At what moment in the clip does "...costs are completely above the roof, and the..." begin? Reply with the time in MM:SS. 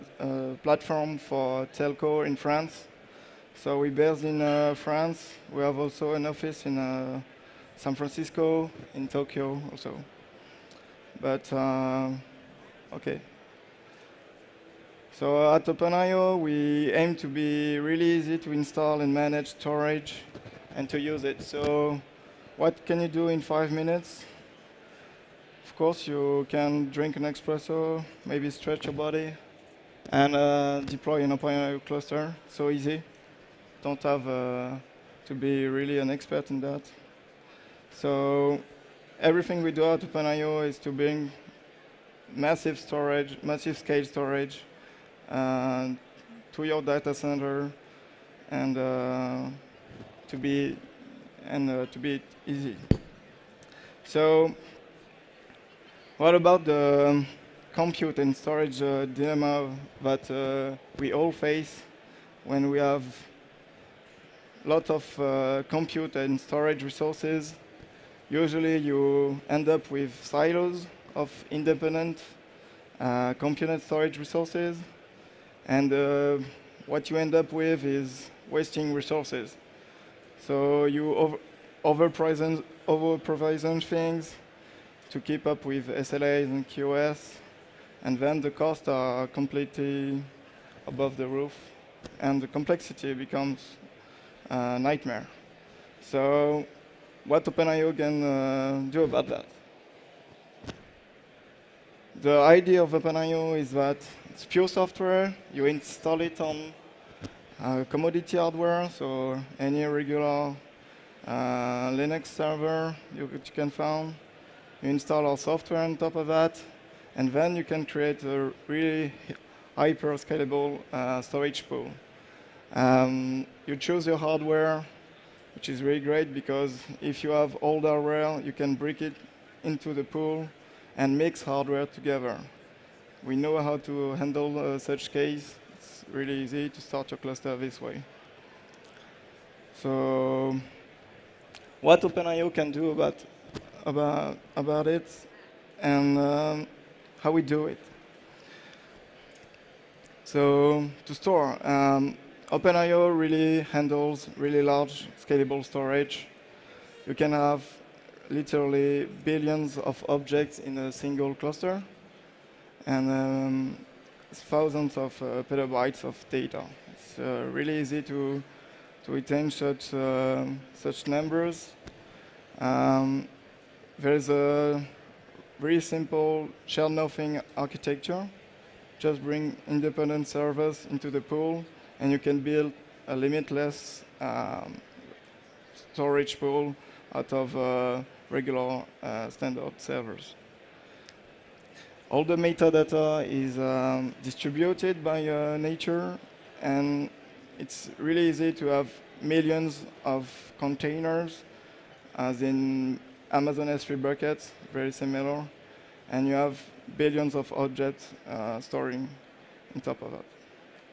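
01:28.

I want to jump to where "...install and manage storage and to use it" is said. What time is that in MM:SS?
00:18.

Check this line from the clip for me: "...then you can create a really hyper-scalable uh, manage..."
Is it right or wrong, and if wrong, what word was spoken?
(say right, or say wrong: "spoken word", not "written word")
wrong: "storage", not "manage".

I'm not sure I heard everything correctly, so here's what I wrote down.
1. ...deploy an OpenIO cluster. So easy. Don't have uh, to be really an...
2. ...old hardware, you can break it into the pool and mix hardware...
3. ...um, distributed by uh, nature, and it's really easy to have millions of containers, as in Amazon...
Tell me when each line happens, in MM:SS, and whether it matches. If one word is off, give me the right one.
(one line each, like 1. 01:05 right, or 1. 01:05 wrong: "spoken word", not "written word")
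1. 00:30 right
2. 02:07 right
3. 03:13 right.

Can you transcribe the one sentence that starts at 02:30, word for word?
So to store, um, OpenIO really handles really large scalable storage.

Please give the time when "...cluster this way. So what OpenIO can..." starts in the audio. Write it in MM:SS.
02:17.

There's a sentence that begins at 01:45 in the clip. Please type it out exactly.
You install it on uh, commodity hardware, so any regular uh, Linux server you, you, can find.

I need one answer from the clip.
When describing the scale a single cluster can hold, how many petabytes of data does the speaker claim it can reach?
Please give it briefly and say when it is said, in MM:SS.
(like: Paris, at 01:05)
thousands, at 02:44.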